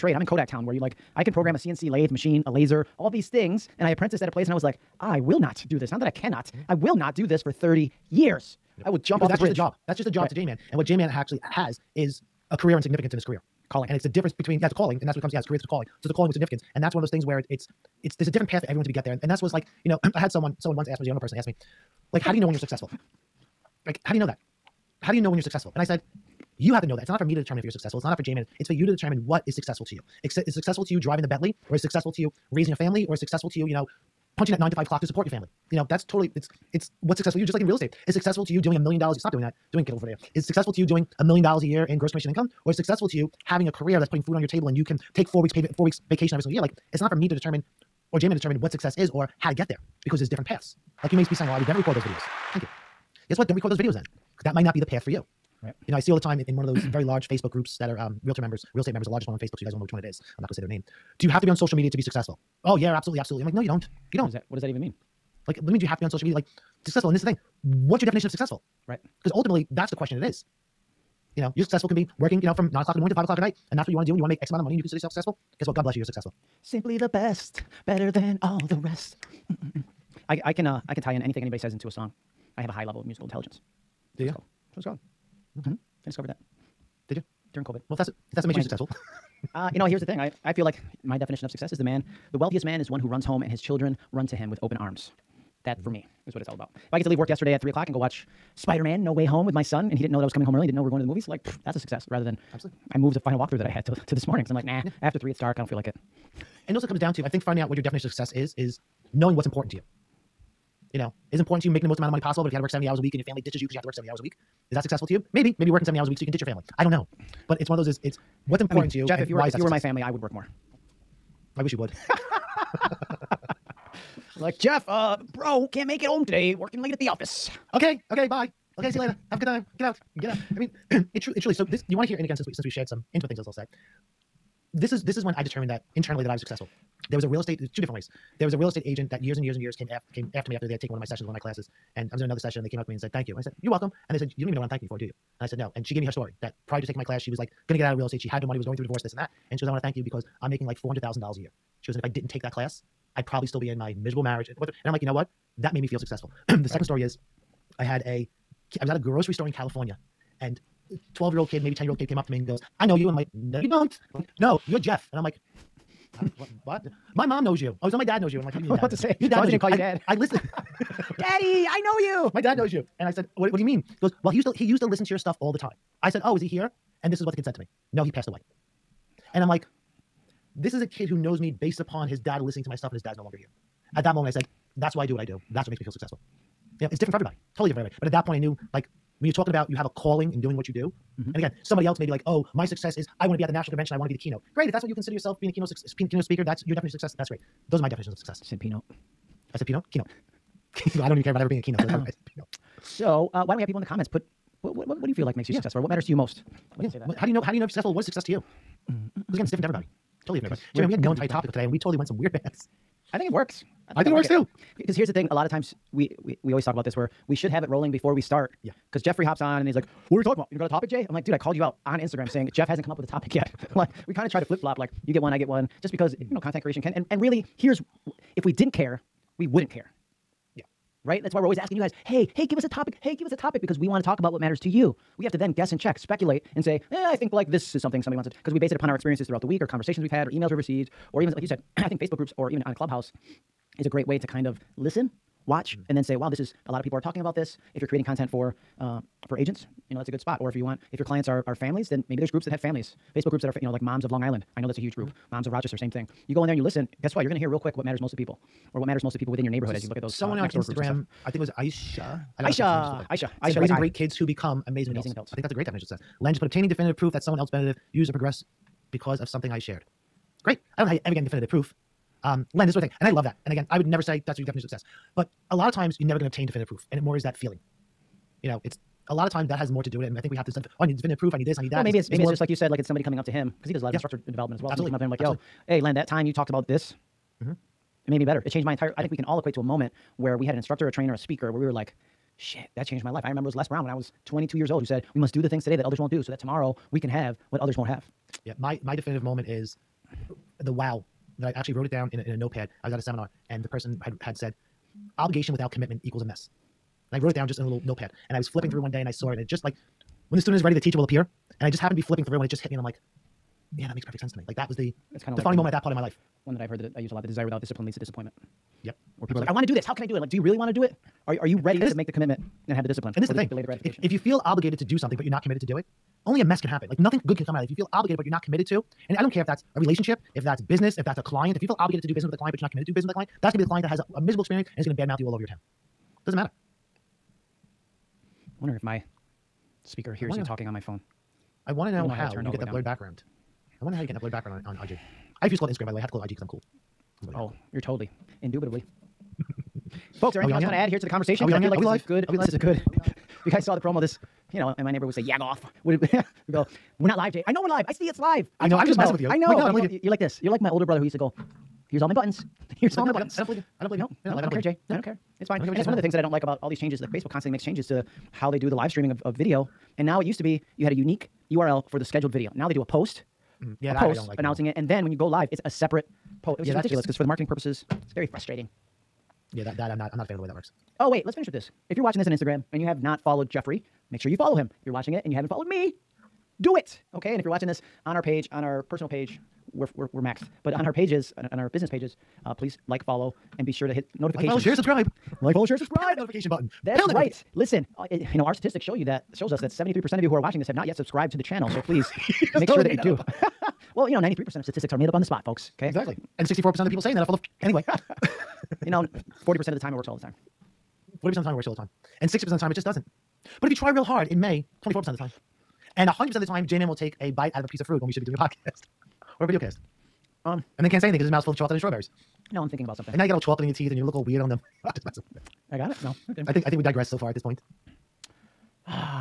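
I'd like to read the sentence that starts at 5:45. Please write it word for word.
I refuse to call it Instagram, by the way.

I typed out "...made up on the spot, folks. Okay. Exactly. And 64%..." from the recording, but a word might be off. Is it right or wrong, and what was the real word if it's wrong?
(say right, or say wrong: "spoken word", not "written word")
right.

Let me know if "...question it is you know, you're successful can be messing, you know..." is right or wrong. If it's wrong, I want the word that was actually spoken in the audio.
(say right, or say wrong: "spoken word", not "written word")
wrong: "working", not "messing".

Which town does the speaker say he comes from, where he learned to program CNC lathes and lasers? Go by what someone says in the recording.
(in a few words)
Kodak Town.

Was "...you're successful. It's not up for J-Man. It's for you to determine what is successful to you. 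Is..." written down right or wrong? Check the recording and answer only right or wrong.
right.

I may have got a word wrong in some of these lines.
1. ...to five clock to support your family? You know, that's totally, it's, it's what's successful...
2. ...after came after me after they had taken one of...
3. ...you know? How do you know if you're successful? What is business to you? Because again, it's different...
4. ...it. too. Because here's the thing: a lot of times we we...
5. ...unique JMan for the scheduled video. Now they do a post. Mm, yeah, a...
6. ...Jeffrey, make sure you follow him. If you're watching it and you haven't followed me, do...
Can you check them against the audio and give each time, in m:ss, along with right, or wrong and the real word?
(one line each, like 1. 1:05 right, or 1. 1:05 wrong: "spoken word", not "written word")
1. 0:34 right
2. 2:19 right
3. 3:27 wrong: "success", not "business"
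4. 3:34 right
5. 6:10 wrong: "URL", not "JMan"
6. 6:23 right.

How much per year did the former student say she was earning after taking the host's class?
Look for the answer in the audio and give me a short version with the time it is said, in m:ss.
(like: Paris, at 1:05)
$400,000, at 2:30.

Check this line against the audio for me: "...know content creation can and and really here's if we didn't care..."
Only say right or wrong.
right.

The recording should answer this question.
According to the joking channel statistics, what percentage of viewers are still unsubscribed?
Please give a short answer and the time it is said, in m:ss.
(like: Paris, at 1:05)
73%, at 6:39.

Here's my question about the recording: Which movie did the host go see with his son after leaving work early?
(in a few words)
Spider Man No Way Home.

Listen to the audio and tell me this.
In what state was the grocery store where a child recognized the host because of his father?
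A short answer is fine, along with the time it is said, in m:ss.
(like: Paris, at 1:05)
California, at 2:39.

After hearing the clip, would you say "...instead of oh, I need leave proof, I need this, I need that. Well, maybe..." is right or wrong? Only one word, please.
wrong.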